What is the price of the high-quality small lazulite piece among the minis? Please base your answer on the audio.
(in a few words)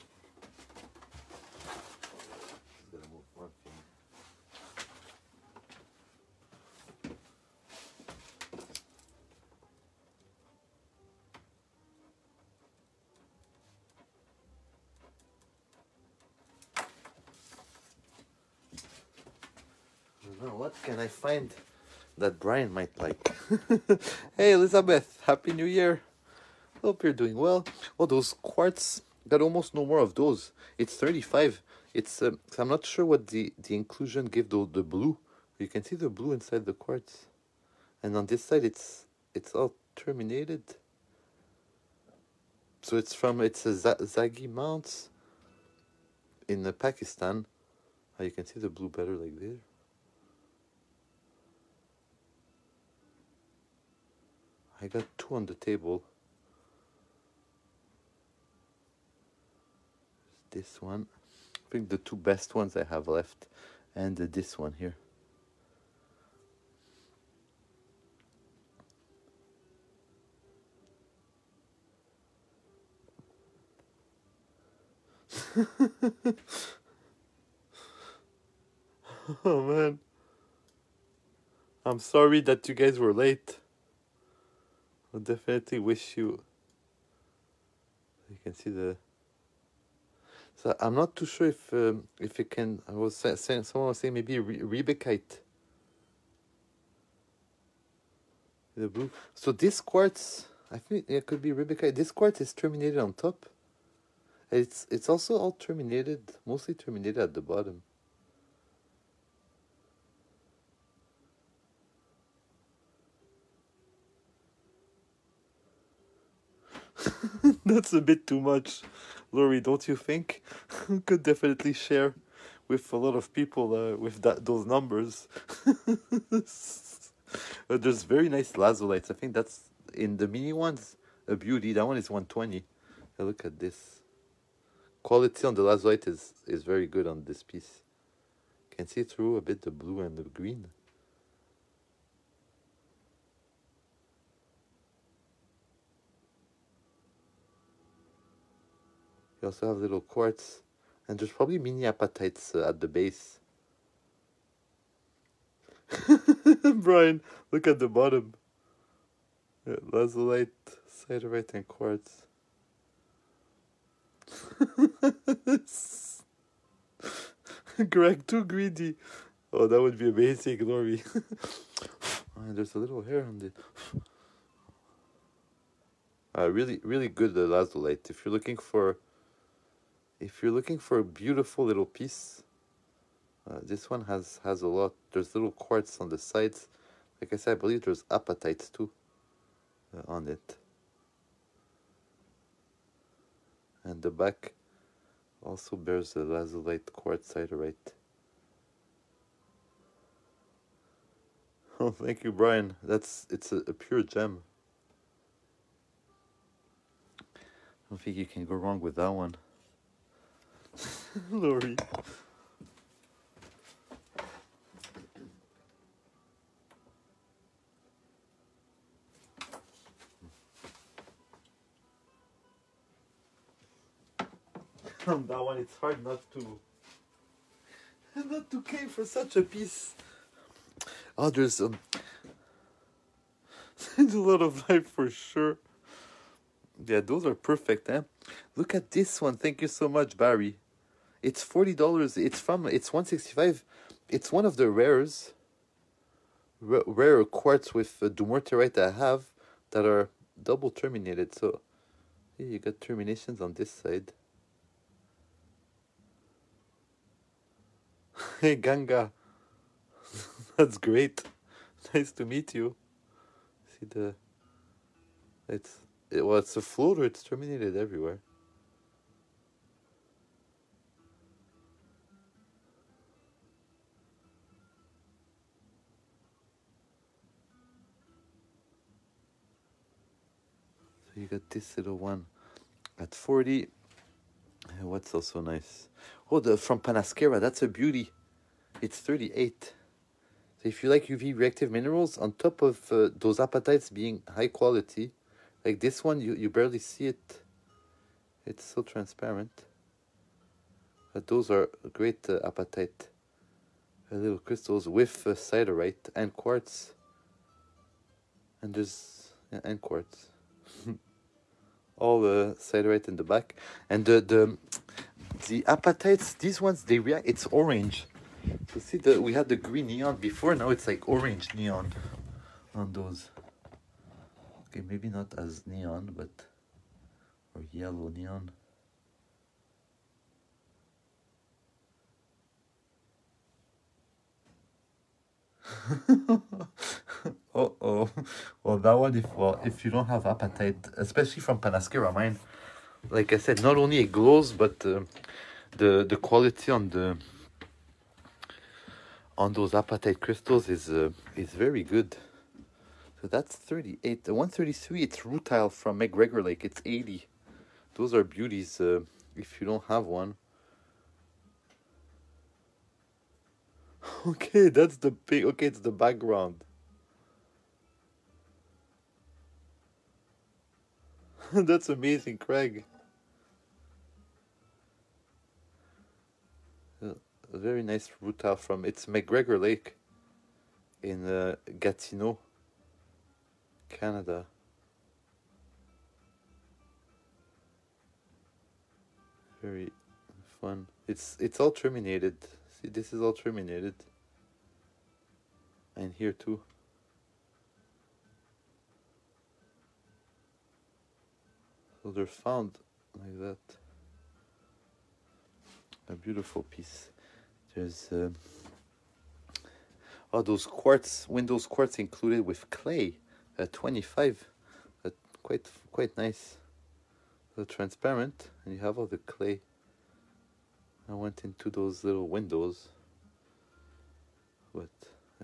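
120.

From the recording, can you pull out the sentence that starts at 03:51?
there's um, there's a lot of life for sure.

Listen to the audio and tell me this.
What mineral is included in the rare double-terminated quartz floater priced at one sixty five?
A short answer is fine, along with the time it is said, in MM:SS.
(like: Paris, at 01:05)
Dumortierite, at 04:08.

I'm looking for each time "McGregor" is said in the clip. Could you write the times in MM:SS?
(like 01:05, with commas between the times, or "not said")
05:55, 06:19.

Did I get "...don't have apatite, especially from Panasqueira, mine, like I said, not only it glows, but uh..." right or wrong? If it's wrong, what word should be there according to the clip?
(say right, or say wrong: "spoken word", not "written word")
right.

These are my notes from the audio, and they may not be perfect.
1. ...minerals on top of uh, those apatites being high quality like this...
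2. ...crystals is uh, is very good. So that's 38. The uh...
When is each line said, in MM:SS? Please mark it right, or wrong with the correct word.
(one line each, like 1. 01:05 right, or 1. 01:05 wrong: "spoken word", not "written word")
1. 04:51 right
2. 05:50 right.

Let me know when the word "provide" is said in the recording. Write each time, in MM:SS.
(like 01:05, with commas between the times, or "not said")
not said.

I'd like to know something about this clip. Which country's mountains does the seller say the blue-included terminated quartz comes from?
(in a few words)
Pakistan.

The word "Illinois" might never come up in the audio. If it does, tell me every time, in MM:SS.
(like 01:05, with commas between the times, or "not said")
not said.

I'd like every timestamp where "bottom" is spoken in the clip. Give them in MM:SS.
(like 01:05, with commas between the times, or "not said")
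01:47, 02:37.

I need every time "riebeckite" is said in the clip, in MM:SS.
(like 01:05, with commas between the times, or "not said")
01:34, 01:41.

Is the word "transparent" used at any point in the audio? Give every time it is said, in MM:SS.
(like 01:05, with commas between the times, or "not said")
04:58, 06:57.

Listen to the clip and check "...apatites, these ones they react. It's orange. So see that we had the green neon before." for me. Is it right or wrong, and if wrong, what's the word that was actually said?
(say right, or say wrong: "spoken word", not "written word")
right.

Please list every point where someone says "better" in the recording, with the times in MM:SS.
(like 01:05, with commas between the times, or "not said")
00:48.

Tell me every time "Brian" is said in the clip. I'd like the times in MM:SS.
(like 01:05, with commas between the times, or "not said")
00:22, 02:36, 03:22.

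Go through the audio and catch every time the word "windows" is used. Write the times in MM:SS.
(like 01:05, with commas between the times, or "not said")
06:51, 07:02.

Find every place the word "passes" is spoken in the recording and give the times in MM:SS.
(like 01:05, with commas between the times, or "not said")
not said.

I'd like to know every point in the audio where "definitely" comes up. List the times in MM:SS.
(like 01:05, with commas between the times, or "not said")
01:25, 02:01.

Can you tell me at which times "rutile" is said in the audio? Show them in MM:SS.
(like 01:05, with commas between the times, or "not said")
05:55, 06:18.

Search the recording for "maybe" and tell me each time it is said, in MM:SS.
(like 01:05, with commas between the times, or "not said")
01:34, 05:24.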